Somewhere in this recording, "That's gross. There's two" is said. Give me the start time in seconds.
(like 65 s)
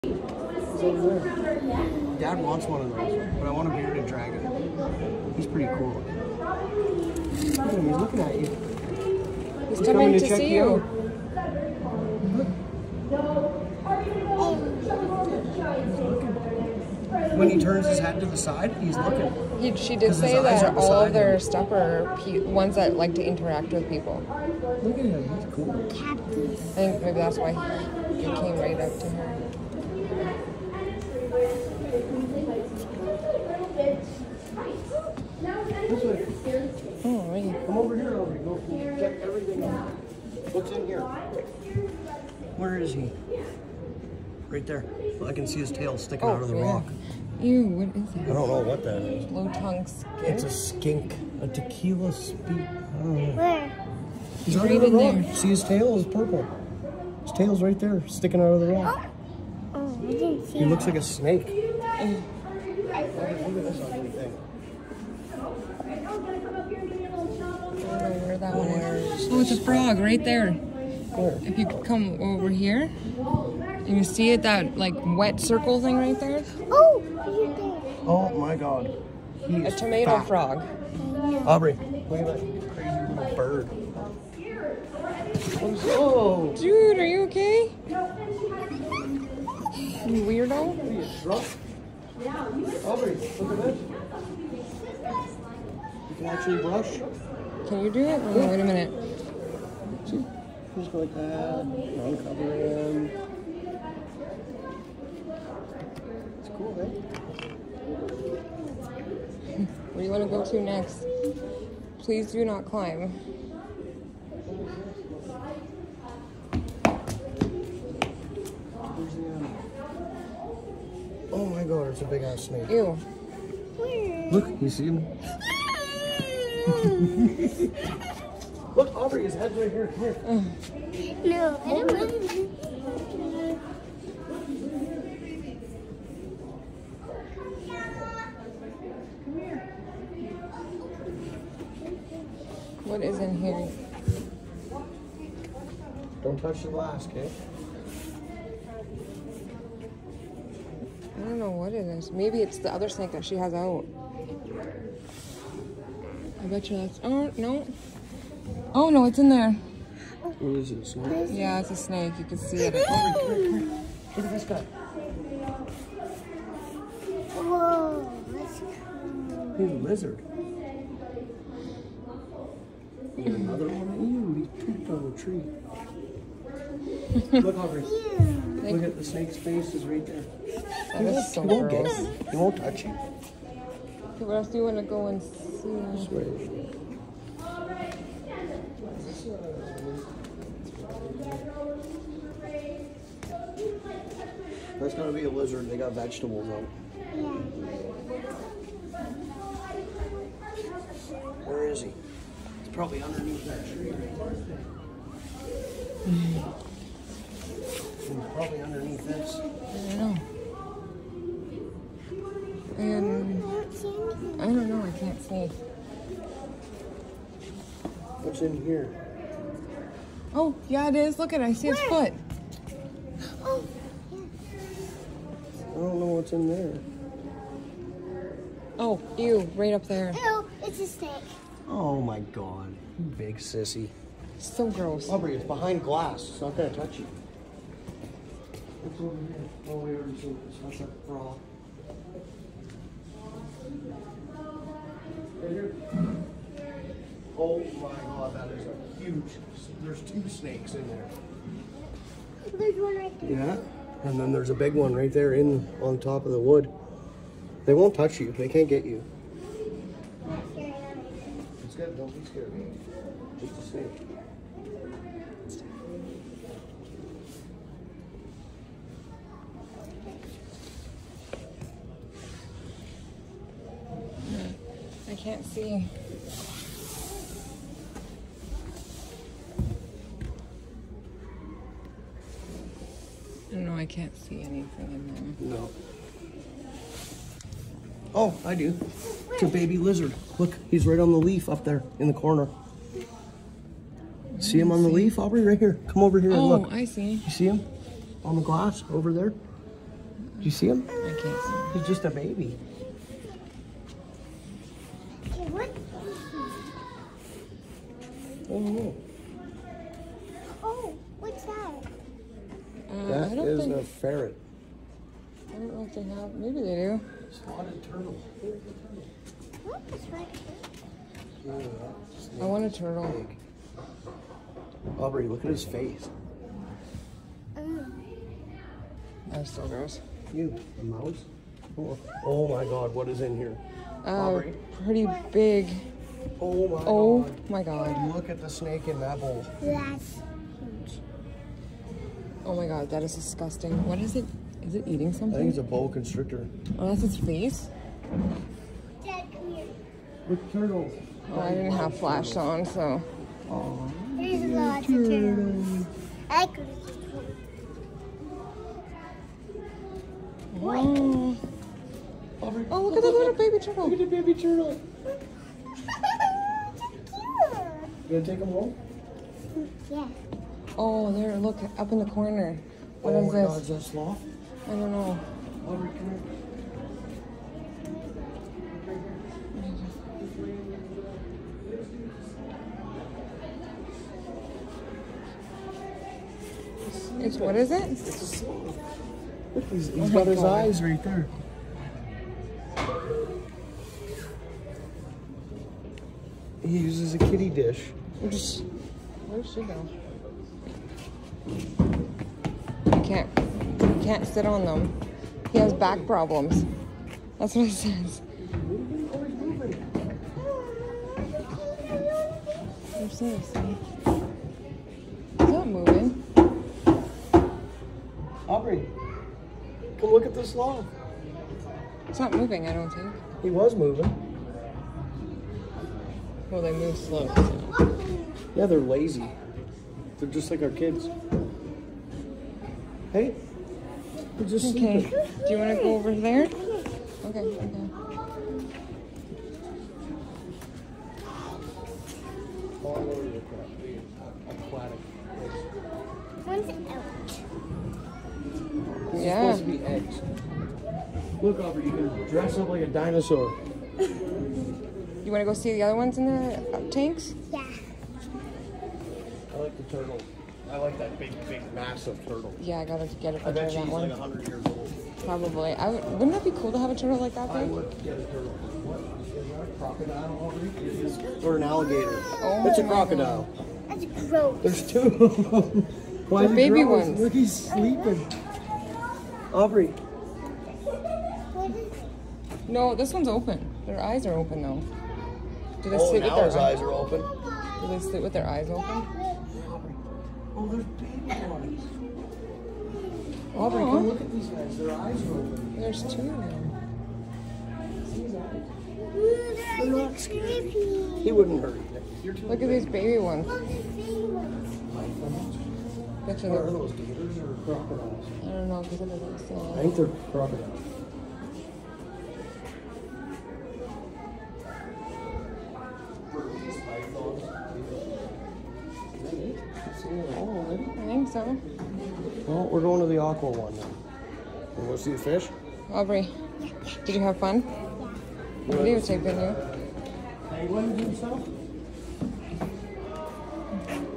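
473 s.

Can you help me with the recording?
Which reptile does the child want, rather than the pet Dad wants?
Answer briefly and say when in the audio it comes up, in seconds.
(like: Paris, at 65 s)
bearded dragon, at 3 s.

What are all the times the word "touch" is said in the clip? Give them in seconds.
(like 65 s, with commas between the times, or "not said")
146 s, 182 s, 236 s, 257 s.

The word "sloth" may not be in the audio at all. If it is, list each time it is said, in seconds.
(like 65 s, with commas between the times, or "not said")
373 s, 388 s.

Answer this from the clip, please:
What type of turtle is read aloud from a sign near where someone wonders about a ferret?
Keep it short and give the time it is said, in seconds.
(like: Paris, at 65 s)
spotted turtle, at 317 s.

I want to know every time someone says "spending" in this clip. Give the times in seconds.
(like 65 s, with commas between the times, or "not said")
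not said.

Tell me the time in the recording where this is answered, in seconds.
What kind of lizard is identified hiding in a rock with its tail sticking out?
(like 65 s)
49 s.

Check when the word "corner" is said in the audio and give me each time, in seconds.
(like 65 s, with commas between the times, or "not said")
292 s, 372 s.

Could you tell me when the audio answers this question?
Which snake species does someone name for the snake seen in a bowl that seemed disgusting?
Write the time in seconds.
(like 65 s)
345 s.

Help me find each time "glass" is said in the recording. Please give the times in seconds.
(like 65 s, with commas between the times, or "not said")
146 s, 235 s, 298 s.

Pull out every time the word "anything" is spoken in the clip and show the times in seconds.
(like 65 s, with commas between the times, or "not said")
284 s.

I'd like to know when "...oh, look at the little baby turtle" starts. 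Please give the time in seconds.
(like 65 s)
362 s.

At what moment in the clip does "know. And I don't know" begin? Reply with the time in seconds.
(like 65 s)
209 s.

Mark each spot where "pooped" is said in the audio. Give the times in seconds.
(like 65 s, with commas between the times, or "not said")
174 s.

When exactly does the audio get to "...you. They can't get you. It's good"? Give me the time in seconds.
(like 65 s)
258 s.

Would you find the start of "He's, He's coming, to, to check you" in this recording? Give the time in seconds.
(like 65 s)
9 s.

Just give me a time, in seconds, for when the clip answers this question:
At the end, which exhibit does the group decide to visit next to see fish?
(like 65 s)
523 s.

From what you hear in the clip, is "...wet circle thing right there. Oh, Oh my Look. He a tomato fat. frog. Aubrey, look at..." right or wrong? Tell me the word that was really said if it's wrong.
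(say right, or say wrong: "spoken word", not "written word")
wrong: "God", not "Look".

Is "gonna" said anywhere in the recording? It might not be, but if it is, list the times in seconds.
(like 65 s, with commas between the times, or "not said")
194 s, 236 s, 368 s.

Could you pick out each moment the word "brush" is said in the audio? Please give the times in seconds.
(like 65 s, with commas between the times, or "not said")
96 s.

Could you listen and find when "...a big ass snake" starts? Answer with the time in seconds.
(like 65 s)
122 s.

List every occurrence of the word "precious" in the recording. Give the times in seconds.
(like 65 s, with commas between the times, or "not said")
not said.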